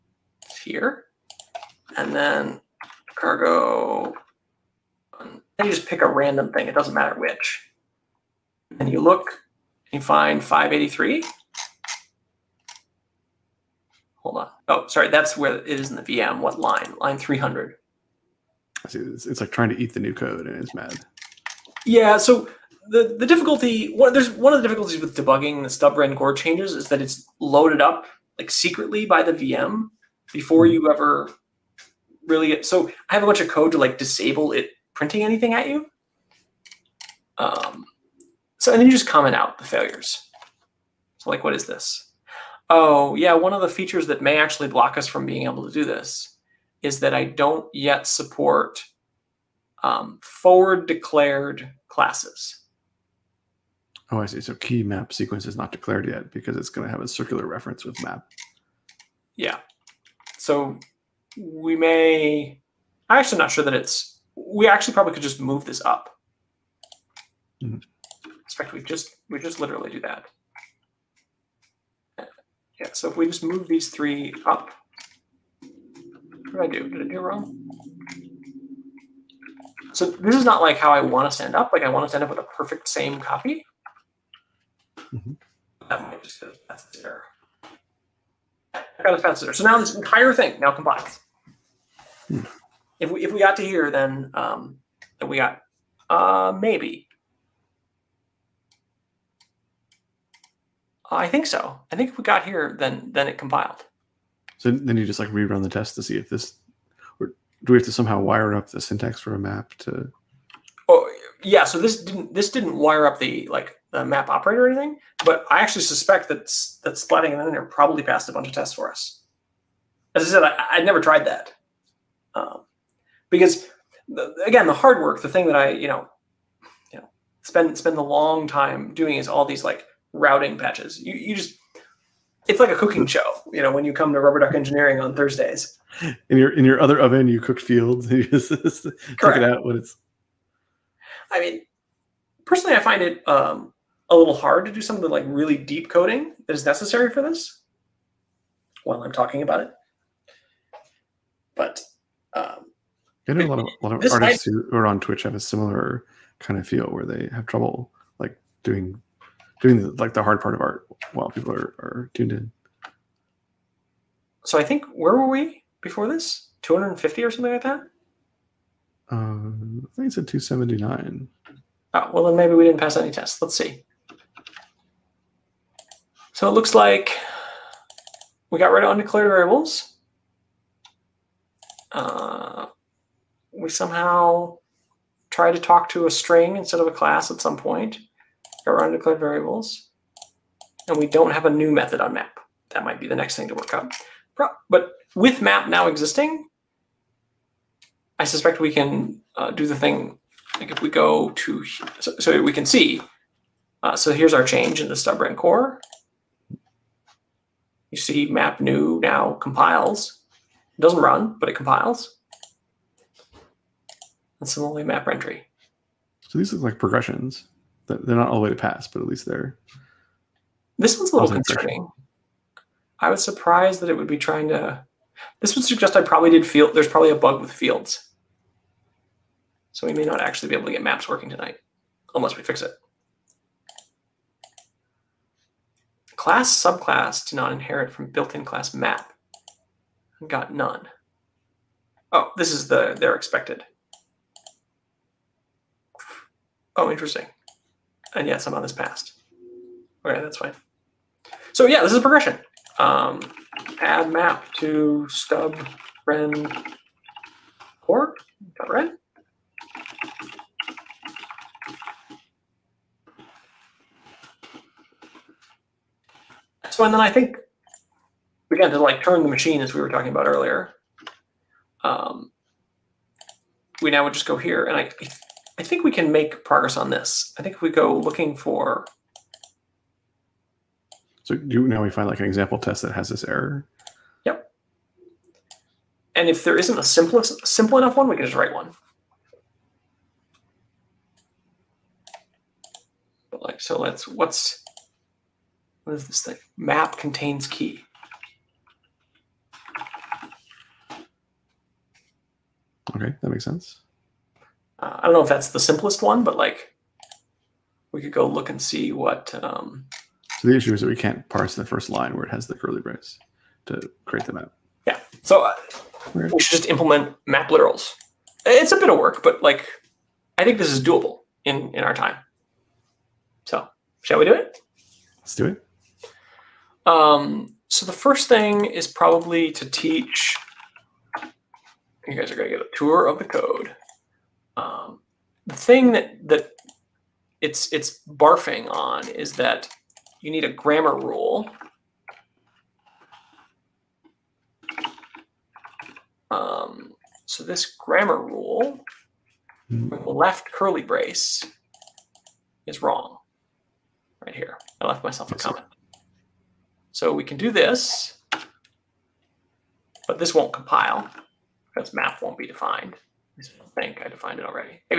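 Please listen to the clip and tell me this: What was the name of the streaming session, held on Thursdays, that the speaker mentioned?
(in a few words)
Rubber Duck Engineering.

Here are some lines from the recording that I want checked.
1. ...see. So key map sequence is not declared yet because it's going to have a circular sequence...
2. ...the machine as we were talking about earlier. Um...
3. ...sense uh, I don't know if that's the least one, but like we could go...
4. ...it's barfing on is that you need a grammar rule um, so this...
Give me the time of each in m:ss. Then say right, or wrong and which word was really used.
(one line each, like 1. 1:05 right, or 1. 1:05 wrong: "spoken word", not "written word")
1. 0:54 wrong: "reference", not "sequence"
2. 4:29 right
3. 5:03 wrong: "simplest", not "least"
4. 5:37 right.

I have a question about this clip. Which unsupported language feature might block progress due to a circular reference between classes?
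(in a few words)
forward declared classes.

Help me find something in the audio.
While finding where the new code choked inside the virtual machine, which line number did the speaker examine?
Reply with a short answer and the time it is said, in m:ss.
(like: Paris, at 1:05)
300, at 0:16.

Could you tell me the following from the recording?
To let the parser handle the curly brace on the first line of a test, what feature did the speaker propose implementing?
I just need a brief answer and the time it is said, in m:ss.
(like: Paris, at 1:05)
map literals, at 5:17.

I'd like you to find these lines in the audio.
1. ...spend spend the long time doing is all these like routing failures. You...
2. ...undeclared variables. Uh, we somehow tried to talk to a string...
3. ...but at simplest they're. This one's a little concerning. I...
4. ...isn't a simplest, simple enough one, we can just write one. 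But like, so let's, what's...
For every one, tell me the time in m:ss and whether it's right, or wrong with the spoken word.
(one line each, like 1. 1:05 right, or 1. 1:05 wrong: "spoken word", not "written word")
1. 2:07 wrong: "patches", not "failures"
2. 2:58 right
3. 3:38 wrong: "least", not "simplest"
4. 4:46 right.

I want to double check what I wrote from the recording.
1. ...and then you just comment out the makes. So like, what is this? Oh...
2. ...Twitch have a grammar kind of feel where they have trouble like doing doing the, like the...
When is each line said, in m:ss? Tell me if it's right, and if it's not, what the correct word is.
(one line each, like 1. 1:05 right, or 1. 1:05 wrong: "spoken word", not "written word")
1. 0:38 wrong: "failures", not "makes"
2. 2:35 wrong: "similar", not "grammar".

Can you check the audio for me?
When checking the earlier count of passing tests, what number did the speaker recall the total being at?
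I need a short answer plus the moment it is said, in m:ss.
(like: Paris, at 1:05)
279, at 2:50.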